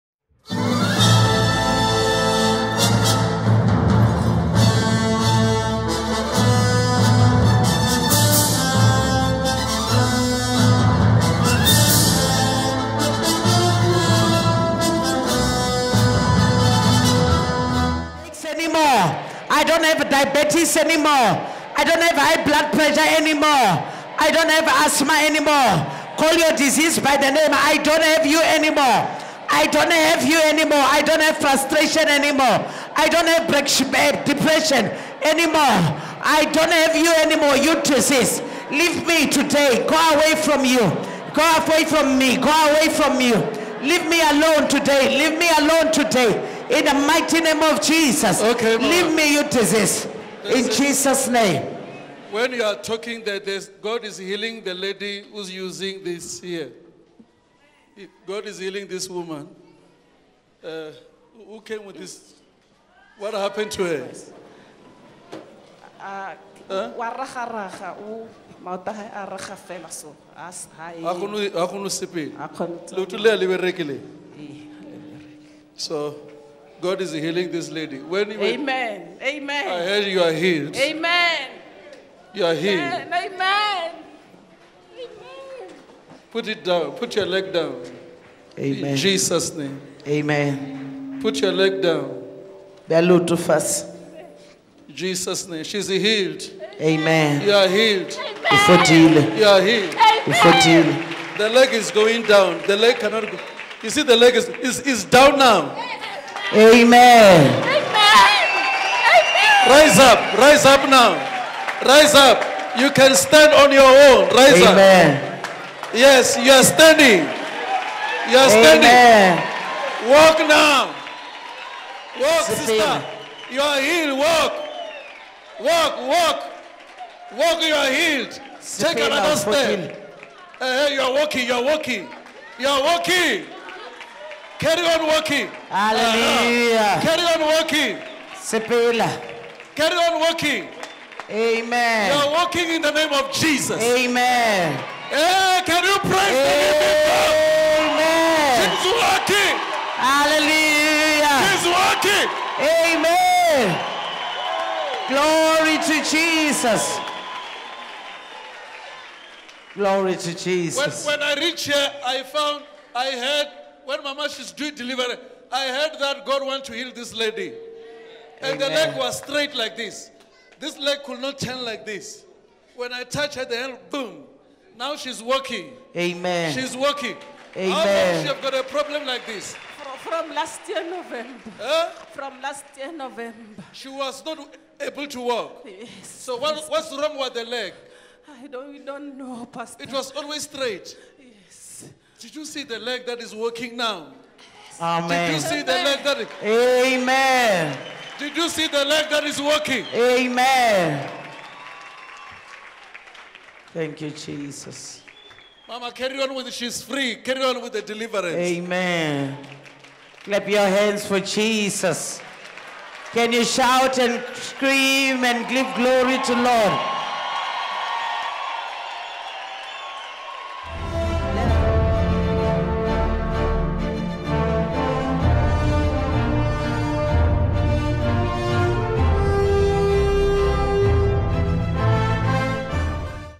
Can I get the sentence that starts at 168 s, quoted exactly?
And the leg was straight like this.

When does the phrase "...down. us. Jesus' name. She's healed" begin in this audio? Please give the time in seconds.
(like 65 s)
91 s.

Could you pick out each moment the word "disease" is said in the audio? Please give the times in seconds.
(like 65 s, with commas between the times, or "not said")
26 s, 37 s, 49 s.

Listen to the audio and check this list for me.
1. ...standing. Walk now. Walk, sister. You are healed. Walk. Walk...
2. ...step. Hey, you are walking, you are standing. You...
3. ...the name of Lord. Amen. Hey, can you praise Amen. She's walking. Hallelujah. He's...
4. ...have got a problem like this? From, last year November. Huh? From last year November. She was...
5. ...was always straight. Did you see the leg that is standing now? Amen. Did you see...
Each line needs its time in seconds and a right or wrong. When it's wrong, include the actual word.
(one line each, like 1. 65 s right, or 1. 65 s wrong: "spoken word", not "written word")
1. 118 s right
2. 129 s wrong: "walking", not "standing"
3. 142 s wrong: "Jesus", not "Lord"
4. 178 s right
5. 189 s wrong: "working", not "standing".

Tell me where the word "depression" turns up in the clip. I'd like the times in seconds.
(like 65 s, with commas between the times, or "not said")
34 s.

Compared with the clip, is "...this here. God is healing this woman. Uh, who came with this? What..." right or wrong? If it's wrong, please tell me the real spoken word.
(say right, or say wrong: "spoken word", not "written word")
right.